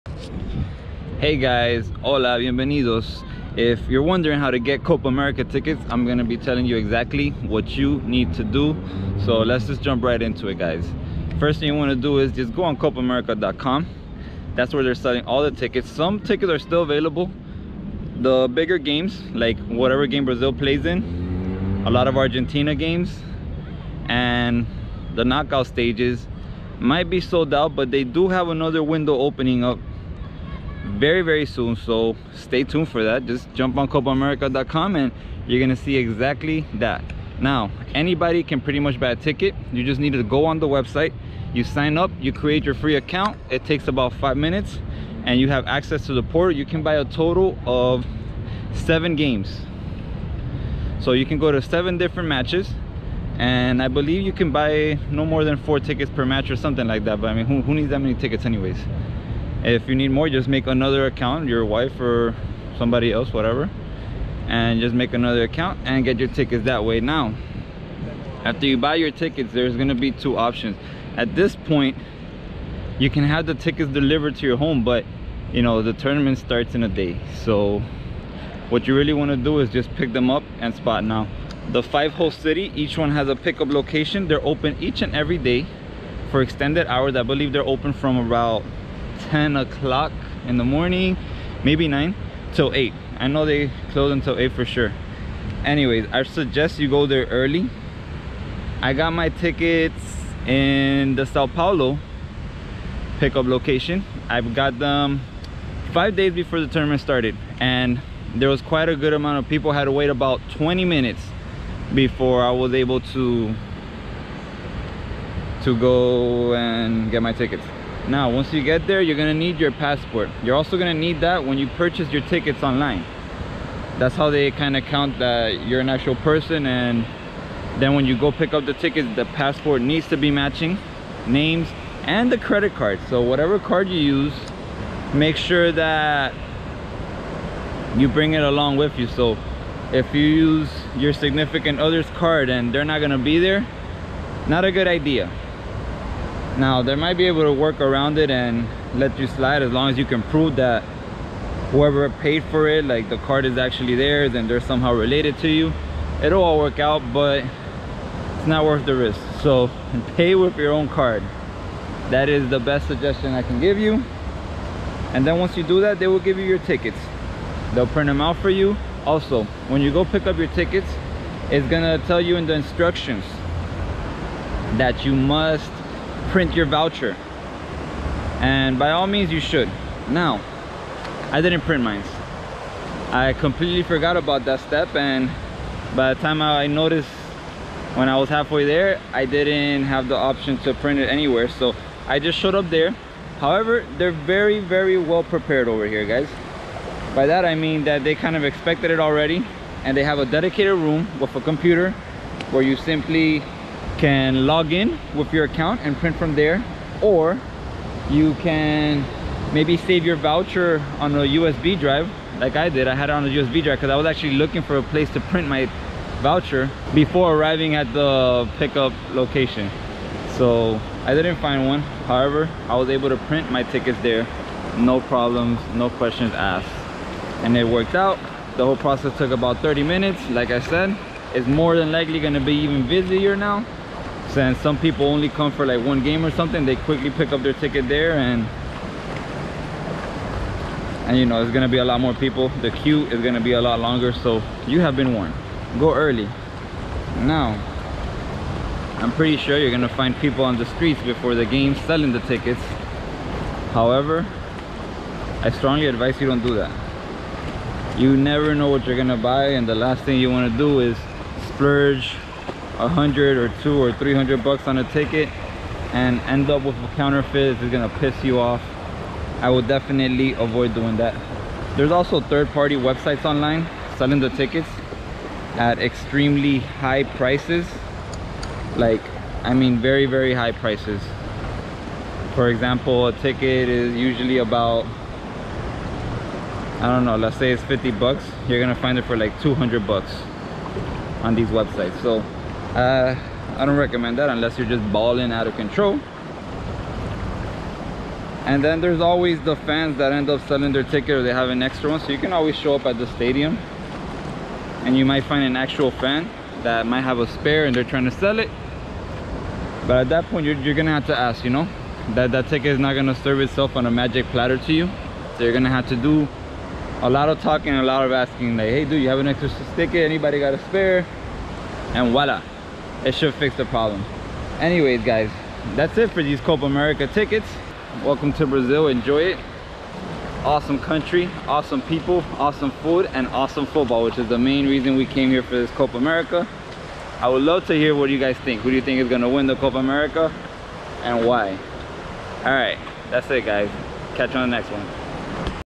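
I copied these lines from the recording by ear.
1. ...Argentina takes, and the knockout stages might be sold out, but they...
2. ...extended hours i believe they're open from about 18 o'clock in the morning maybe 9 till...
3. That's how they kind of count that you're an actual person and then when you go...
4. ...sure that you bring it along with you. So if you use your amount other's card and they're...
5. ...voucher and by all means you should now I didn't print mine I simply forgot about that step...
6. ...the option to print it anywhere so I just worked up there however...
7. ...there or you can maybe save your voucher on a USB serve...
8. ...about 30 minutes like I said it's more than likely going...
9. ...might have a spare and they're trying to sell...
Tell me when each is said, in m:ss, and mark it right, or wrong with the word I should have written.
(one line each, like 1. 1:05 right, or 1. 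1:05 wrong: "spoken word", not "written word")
1. 0:22 wrong: "games", not "takes"
2. 1:26 wrong: "10", not "18"
3. 2:03 right
4. 2:15 wrong: "significant", not "amount"
5. 2:56 wrong: "completely", not "simply"
6. 3:10 wrong: "showed", not "worked"
7. 3:26 wrong: "drive", not "serve"
8. 3:49 right
9. 5:06 right.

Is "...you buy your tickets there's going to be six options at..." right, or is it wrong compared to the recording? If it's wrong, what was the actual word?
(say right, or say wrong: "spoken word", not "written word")
wrong: "two", not "six".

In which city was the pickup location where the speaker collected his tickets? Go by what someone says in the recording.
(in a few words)
Sao Paulo.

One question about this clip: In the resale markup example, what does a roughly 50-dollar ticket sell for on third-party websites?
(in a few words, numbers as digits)
200 dollars.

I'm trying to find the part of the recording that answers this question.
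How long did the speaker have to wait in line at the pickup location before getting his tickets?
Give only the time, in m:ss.
1:50.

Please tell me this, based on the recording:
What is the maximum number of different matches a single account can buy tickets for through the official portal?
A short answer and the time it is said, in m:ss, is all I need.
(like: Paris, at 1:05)
7, at 0:48.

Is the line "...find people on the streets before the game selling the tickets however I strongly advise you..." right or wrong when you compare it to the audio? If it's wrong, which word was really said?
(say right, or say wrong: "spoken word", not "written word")
right.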